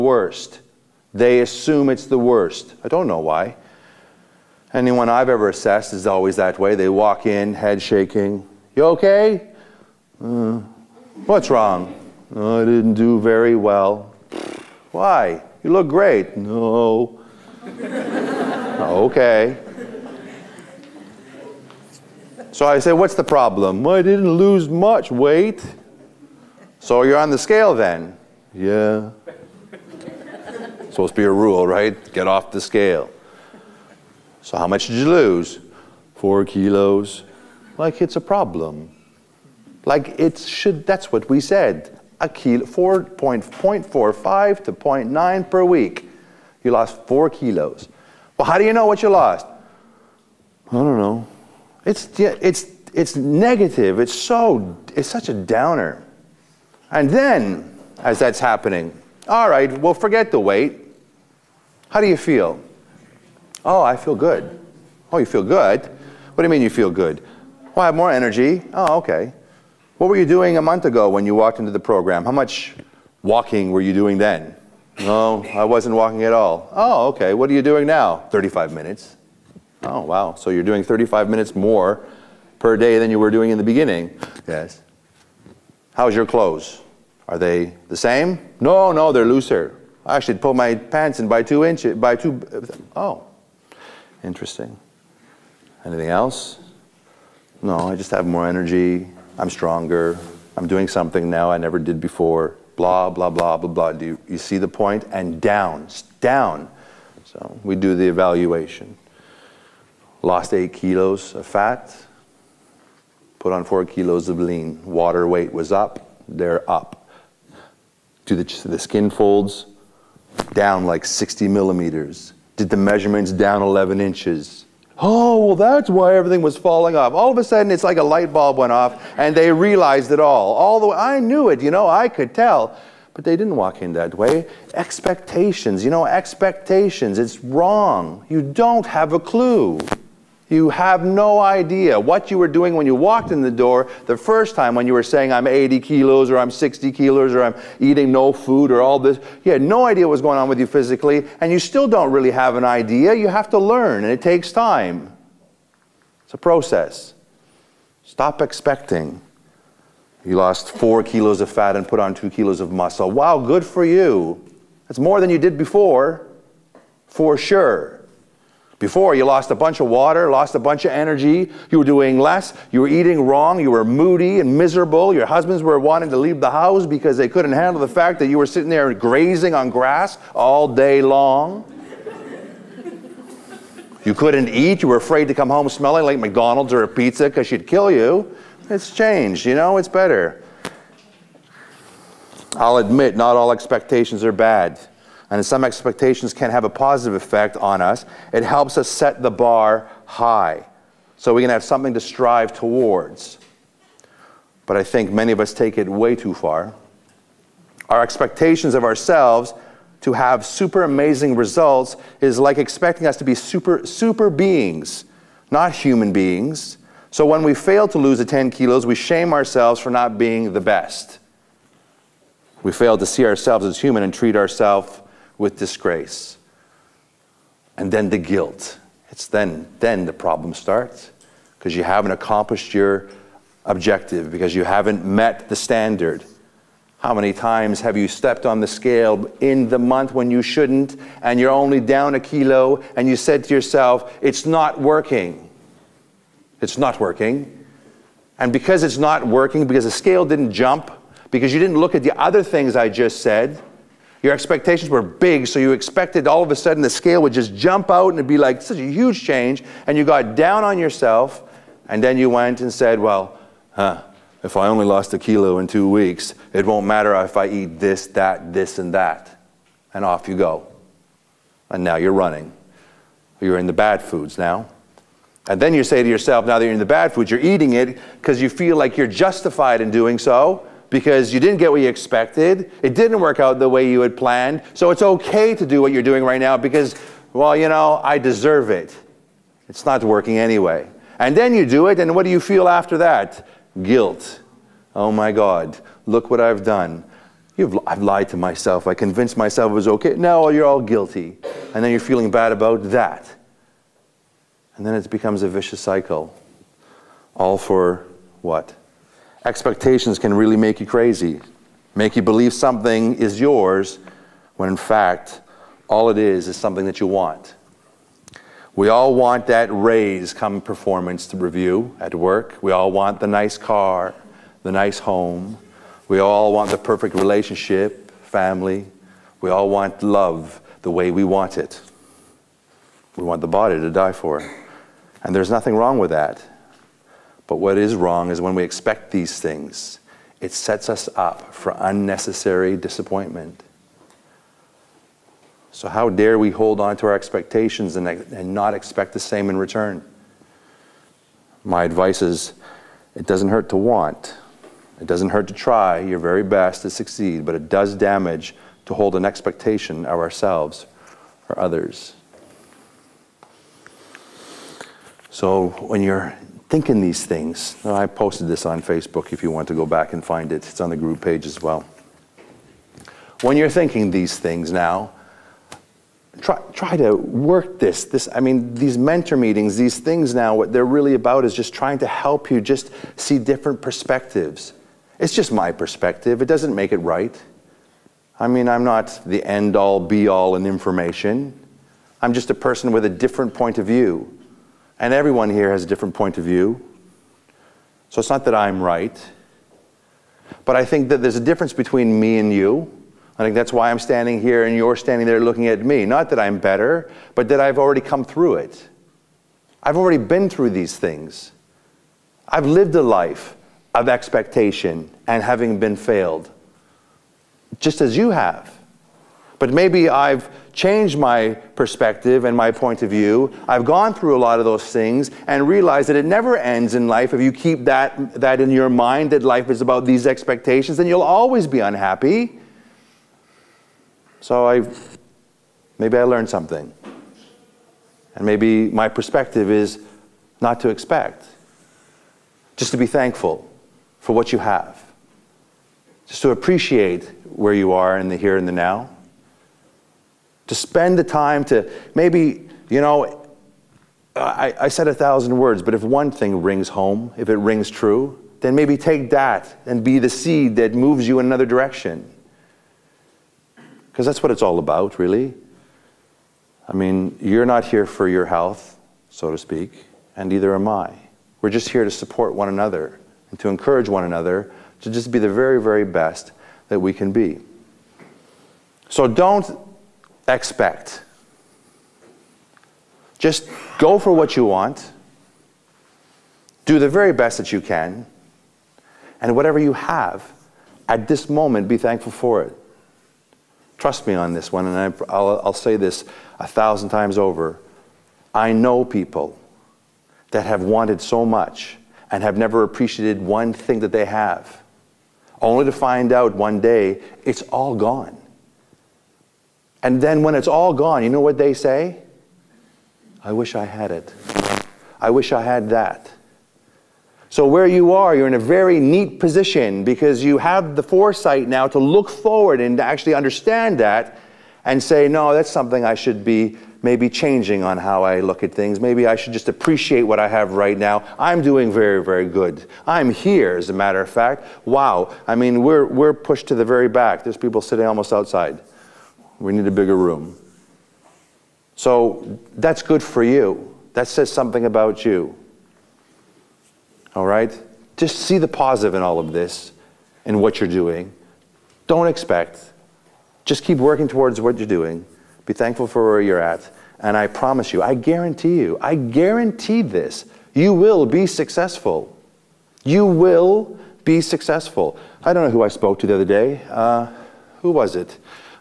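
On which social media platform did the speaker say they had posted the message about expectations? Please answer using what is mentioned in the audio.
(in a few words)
Facebook.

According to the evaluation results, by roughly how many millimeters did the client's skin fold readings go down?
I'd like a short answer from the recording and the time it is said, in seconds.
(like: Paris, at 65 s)
60 millimeters, at 121 s.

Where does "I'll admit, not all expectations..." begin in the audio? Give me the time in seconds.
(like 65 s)
192 s.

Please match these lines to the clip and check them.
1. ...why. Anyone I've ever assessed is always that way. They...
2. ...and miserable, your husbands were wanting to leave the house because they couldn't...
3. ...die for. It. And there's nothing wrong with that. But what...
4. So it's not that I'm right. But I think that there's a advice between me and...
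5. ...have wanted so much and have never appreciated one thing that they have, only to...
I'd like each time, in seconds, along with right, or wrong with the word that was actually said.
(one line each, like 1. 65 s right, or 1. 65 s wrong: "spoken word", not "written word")
1. 3 s right
2. 174 s right
3. 333 s right
4. 398 s wrong: "difference", not "advice"
5. 500 s right.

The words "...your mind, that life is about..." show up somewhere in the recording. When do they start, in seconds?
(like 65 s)
428 s.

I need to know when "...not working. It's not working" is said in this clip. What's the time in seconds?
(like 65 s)
244 s.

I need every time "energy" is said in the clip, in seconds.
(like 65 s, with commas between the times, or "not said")
68 s, 98 s, 170 s.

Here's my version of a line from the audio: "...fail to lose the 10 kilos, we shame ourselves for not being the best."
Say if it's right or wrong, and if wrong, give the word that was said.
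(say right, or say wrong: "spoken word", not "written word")
right.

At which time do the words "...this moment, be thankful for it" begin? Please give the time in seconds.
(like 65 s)
491 s.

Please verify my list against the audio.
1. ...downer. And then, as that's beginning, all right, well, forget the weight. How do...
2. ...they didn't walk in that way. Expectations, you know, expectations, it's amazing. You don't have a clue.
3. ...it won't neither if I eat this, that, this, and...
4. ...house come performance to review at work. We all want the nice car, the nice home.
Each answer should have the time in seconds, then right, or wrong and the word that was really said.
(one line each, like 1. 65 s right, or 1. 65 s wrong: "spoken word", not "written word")
1. 55 s wrong: "happening", not "beginning"
2. 133 s wrong: "wrong", not "amazing"
3. 266 s wrong: "matter", not "neither"
4. 319 s wrong: "raise", not "house".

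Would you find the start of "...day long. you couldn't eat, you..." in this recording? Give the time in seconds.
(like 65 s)
180 s.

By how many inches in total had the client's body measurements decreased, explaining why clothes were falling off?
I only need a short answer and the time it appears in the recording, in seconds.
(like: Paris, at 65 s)
11 inches, at 123 s.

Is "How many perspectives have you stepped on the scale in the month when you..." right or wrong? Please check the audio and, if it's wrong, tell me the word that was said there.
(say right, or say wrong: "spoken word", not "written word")
wrong: "times", not "perspectives".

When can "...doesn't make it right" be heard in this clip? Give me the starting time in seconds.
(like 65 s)
386 s.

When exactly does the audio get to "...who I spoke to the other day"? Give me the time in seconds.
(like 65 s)
565 s.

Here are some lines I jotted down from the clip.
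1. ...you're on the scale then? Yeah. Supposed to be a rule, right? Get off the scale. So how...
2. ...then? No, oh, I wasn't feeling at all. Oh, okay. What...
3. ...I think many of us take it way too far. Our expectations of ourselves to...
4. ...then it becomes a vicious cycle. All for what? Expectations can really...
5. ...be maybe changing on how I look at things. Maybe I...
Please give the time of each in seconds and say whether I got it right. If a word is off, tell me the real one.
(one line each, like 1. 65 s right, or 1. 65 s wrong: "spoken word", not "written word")
1. 27 s right
2. 74 s wrong: "walking", not "feeling"
3. 204 s right
4. 304 s right
5. 526 s right.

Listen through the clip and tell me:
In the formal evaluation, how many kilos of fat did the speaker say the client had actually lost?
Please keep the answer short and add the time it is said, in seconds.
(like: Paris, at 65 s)
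8 kilos, at 110 s.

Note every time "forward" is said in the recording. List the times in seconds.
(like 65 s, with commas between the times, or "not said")
522 s.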